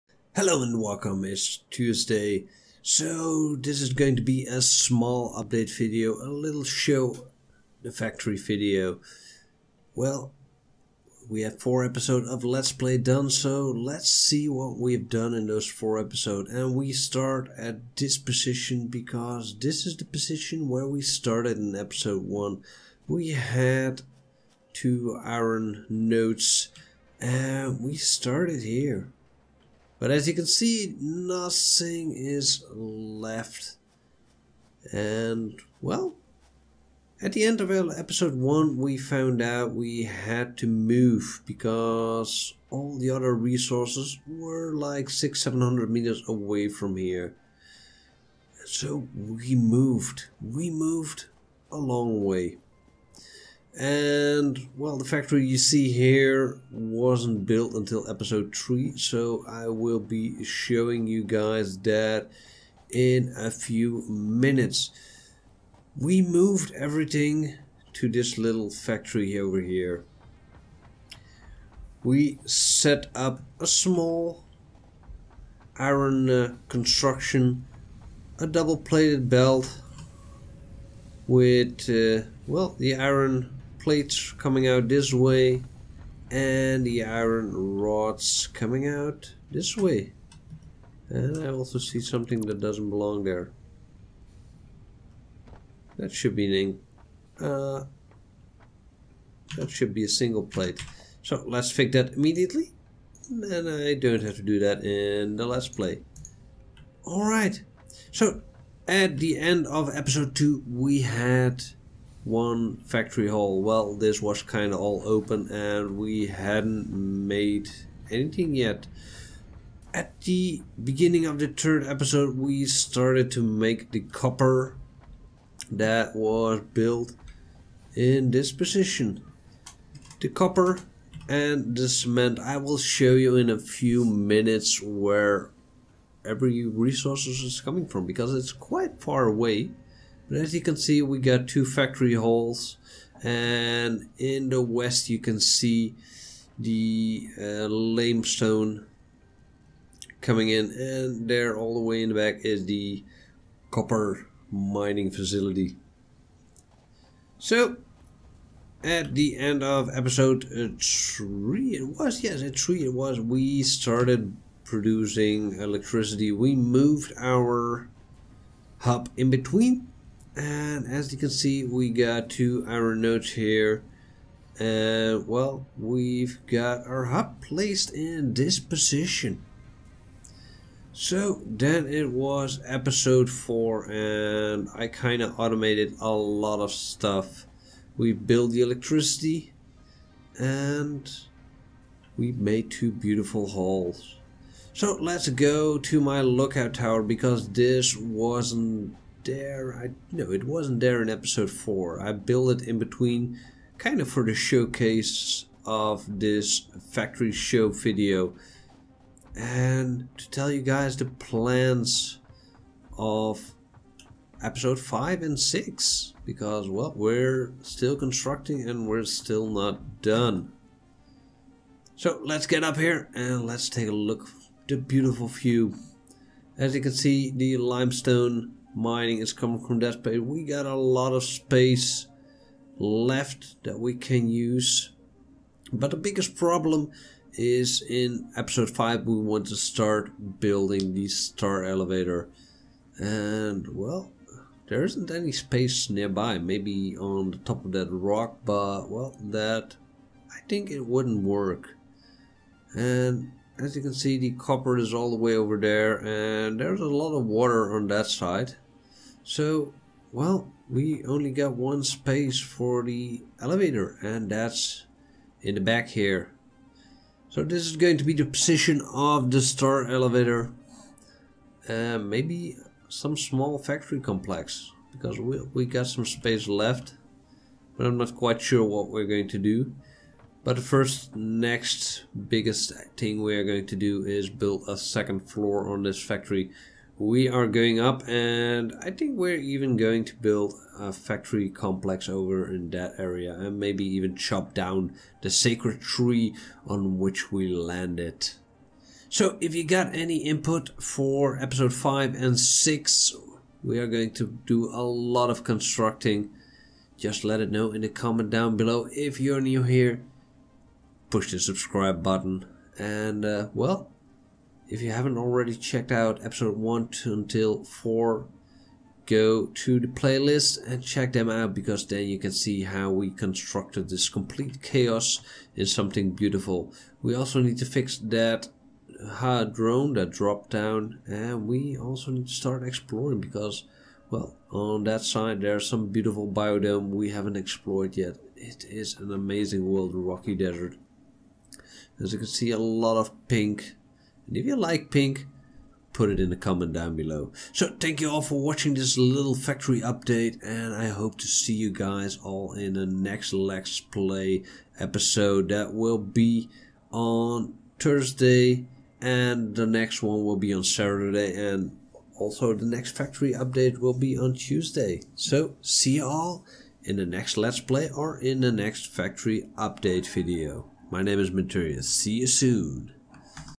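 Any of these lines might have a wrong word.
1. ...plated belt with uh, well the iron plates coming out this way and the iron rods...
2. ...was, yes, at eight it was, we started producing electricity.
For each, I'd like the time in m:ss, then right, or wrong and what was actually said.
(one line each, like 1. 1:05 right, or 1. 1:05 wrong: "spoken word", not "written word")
1. 1:18 right
2. 2:41 wrong: "three", not "eight".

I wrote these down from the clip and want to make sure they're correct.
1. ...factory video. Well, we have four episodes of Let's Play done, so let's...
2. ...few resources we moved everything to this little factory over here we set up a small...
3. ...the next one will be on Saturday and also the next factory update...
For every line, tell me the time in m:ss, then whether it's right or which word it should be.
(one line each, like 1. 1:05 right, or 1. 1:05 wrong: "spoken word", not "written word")
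1. 0:07 right
2. 1:03 wrong: "minutes", not "resources"
3. 5:59 right.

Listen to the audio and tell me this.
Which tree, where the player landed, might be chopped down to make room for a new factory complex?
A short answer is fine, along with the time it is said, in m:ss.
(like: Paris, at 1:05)
The sacred tree, at 4:55.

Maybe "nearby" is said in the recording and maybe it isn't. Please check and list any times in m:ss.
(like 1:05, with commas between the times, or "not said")
4:05.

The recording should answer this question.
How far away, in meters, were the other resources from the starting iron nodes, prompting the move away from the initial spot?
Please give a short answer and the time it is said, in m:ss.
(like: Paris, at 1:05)
600-700 meters, at 0:45.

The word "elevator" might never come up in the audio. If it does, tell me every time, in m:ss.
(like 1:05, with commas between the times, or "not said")
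4:01, 4:23, 4:29.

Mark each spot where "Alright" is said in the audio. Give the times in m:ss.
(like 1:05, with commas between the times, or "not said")
1:47.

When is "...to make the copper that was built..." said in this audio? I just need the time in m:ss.
2:03.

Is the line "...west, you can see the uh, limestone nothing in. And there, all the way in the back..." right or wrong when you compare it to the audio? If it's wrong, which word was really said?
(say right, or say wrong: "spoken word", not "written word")
wrong: "coming", not "nothing".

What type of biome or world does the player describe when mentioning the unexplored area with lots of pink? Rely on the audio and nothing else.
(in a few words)
Rocky desert.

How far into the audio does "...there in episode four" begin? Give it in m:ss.
3:20.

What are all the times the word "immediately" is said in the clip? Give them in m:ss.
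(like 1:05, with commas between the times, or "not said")
1:42.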